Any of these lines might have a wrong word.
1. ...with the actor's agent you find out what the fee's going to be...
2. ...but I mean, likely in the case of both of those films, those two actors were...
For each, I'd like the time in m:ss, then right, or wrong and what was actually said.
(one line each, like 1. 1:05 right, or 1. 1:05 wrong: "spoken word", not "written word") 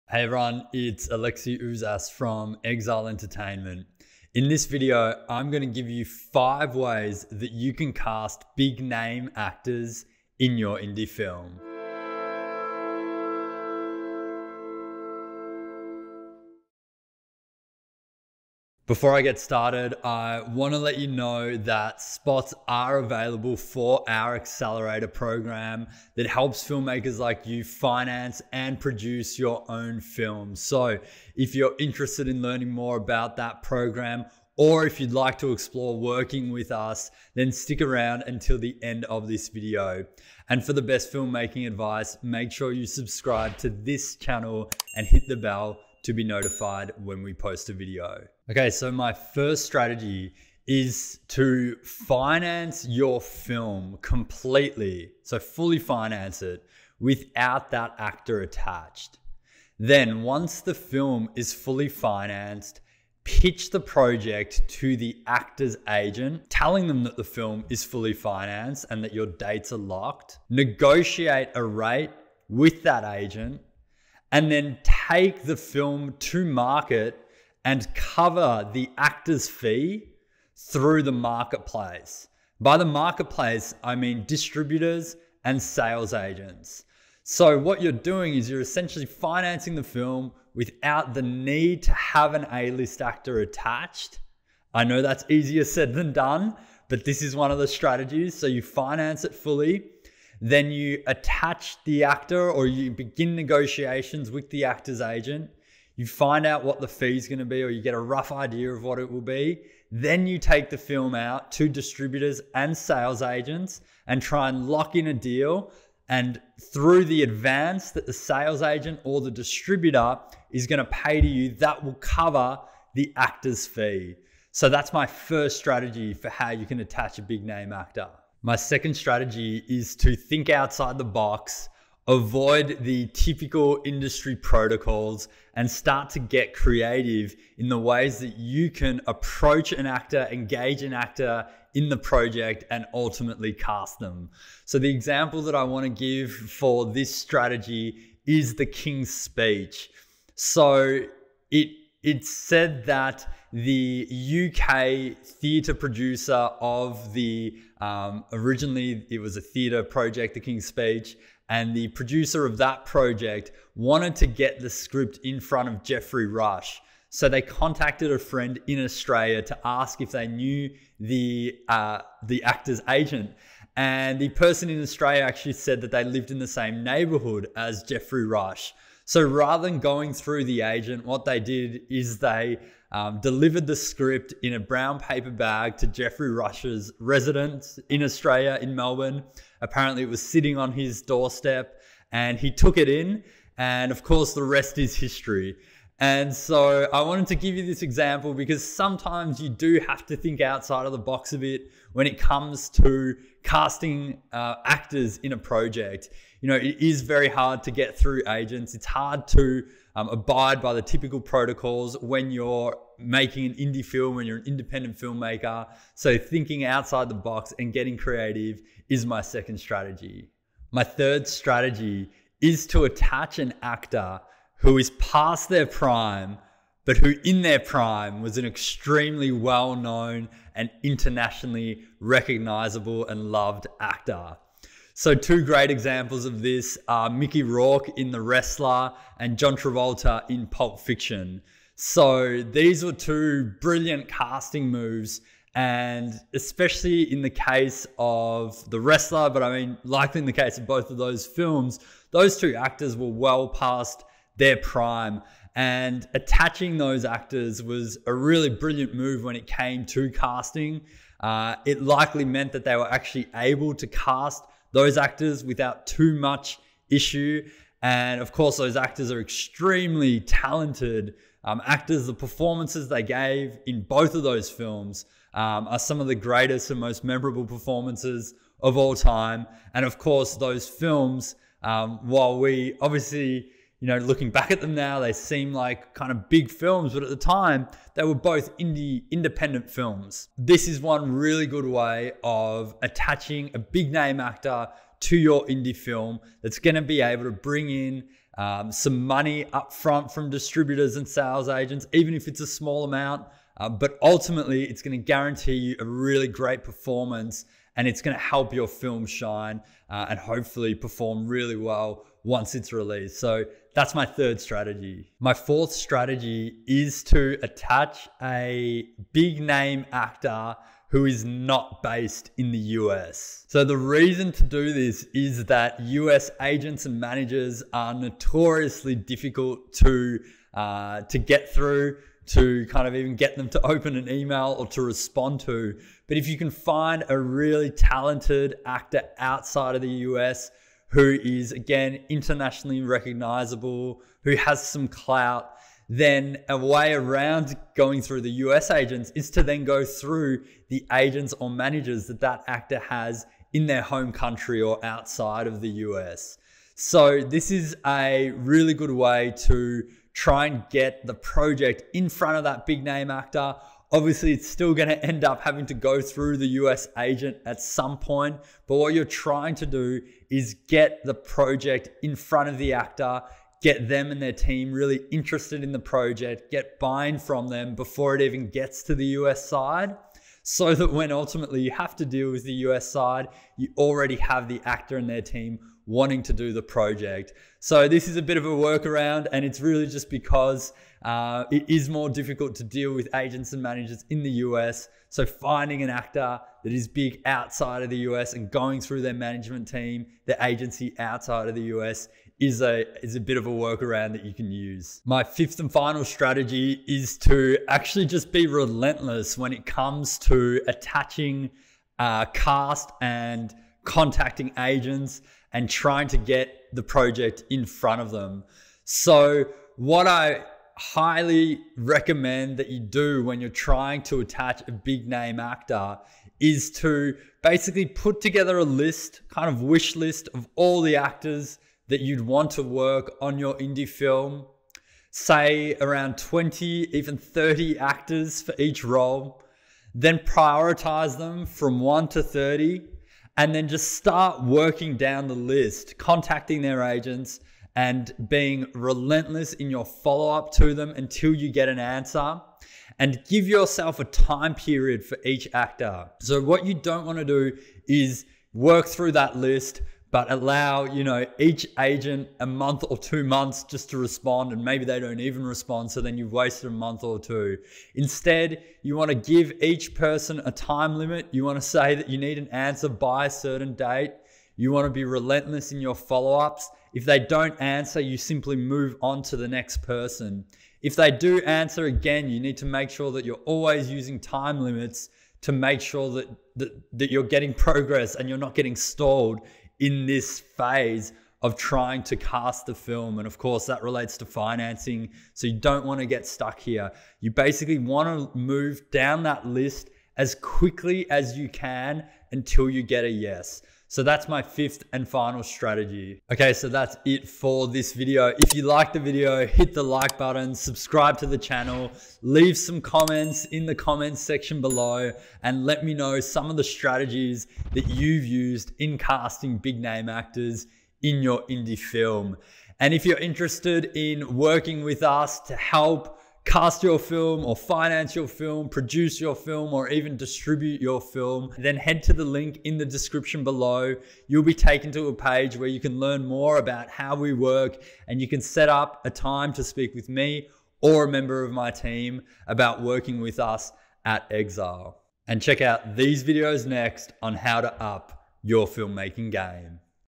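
1. 1:44 right
2. 4:09 right.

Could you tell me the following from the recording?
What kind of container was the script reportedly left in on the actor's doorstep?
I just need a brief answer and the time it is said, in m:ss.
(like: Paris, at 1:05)
brown paper bag, at 3:04.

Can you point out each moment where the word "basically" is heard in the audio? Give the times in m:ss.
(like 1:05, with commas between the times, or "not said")
7:07, 8:17.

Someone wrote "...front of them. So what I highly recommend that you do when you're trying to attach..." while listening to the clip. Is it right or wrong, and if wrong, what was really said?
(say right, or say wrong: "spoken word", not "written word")
right.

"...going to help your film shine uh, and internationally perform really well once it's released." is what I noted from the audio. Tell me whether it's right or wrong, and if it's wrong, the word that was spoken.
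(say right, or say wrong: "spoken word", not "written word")
wrong: "hopefully", not "internationally".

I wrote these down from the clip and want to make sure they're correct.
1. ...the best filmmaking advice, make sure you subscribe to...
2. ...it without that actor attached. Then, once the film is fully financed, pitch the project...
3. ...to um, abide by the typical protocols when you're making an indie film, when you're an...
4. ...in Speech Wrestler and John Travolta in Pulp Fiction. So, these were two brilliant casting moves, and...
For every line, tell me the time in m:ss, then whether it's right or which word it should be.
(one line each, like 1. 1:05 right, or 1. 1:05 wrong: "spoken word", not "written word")
1. 0:40 right
2. 0:56 right
3. 3:29 right
4. 3:57 wrong: "The", not "Speech".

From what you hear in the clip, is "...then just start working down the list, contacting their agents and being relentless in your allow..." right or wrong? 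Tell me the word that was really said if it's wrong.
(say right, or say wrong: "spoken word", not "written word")
wrong: "follow", not "allow".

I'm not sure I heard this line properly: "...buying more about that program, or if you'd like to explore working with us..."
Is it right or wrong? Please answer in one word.
wrong.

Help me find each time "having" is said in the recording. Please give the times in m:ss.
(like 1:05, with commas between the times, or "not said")
6:05.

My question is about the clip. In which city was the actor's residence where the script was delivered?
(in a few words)
Melbourne.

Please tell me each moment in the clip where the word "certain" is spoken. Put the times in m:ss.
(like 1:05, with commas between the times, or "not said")
7:53.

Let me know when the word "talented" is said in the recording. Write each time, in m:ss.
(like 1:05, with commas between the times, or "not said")
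4:30, 5:37.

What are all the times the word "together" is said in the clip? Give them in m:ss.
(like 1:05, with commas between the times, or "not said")
7:08.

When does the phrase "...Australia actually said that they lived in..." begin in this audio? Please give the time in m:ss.
2:54.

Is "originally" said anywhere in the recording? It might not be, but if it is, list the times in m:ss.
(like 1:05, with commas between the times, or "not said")
2:38.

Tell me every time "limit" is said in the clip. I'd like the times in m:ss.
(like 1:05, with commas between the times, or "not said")
7:50, 8:04.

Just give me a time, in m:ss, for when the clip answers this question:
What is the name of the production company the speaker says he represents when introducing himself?
0:02.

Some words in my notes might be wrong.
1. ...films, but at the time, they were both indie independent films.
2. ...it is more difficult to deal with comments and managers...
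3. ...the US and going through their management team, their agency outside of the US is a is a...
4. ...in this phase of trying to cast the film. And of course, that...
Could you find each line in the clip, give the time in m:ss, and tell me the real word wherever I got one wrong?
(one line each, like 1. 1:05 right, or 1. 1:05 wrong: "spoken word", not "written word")
1. 4:46 right
2. 6:31 wrong: "agents", not "comments"
3. 6:37 right
4. 8:09 right.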